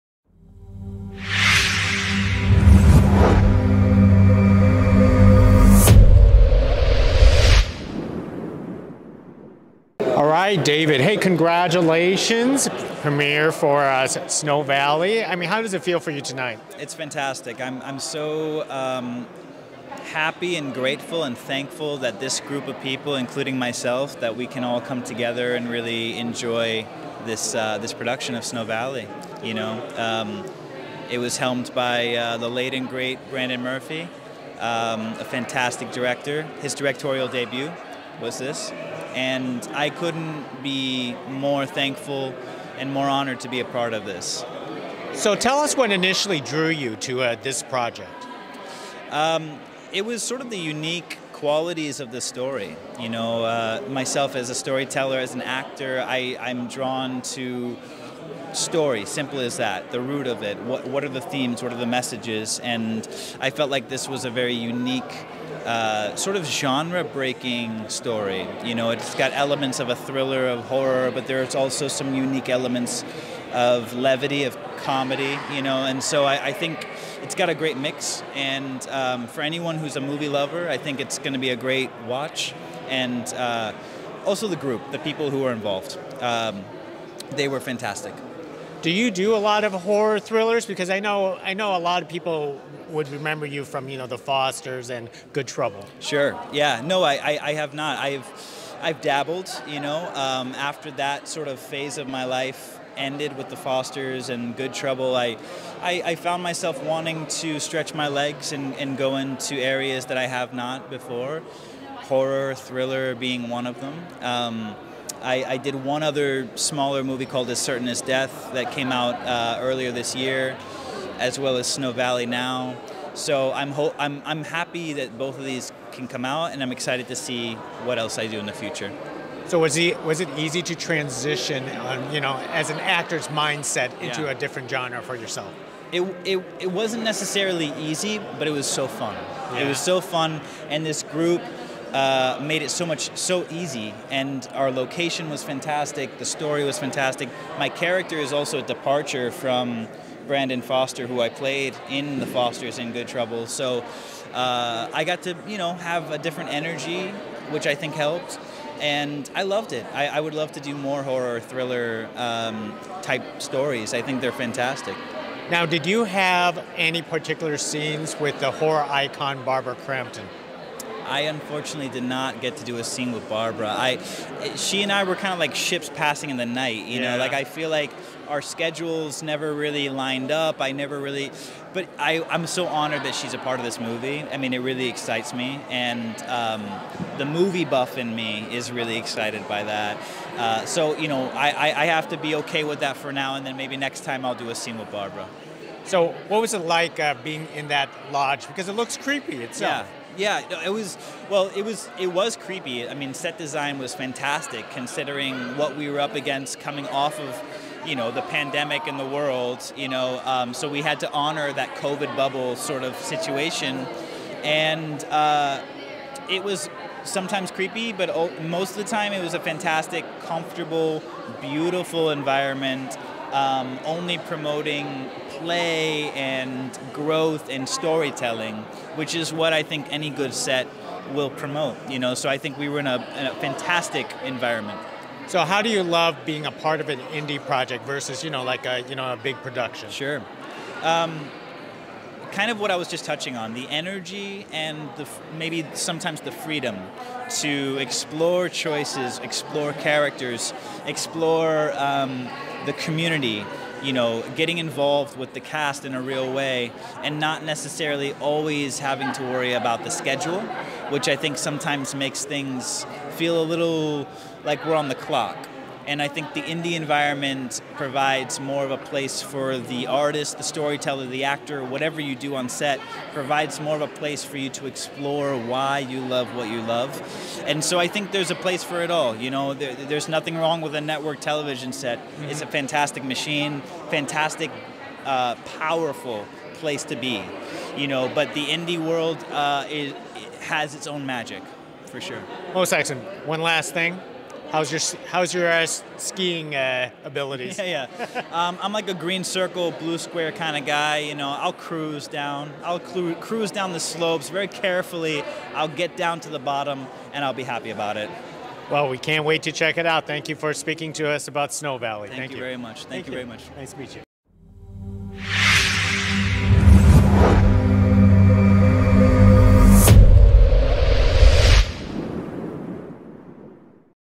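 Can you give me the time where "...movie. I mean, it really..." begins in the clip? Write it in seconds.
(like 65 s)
183 s.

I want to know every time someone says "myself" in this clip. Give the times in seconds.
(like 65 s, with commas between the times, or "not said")
23 s, 53 s, 106 s.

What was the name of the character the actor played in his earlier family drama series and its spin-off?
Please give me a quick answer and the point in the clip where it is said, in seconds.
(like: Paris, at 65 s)
Brandon Foster, at 150 s.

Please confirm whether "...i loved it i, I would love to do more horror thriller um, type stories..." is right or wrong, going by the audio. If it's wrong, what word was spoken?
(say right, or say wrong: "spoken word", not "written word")
right.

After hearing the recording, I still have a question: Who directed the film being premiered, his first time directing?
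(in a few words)
Brandon Murphy.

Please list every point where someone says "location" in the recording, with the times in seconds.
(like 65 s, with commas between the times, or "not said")
144 s.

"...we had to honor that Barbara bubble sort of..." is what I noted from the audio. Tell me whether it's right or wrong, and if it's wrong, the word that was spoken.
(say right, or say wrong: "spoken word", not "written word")
wrong: "COVID", not "Barbara".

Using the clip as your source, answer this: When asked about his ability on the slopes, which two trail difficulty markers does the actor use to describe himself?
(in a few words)
green circle, blue square.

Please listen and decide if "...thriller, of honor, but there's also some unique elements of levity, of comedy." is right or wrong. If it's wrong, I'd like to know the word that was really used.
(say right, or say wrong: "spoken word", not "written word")
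wrong: "horror", not "honor".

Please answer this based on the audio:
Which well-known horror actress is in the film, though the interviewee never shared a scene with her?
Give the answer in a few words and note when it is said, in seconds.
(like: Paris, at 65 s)
Barbara Crampton, at 169 s.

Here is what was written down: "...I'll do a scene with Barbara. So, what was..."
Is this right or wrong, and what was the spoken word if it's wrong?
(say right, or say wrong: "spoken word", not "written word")
right.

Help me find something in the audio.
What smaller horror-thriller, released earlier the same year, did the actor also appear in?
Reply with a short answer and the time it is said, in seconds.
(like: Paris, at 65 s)
As Certain as Death, at 117 s.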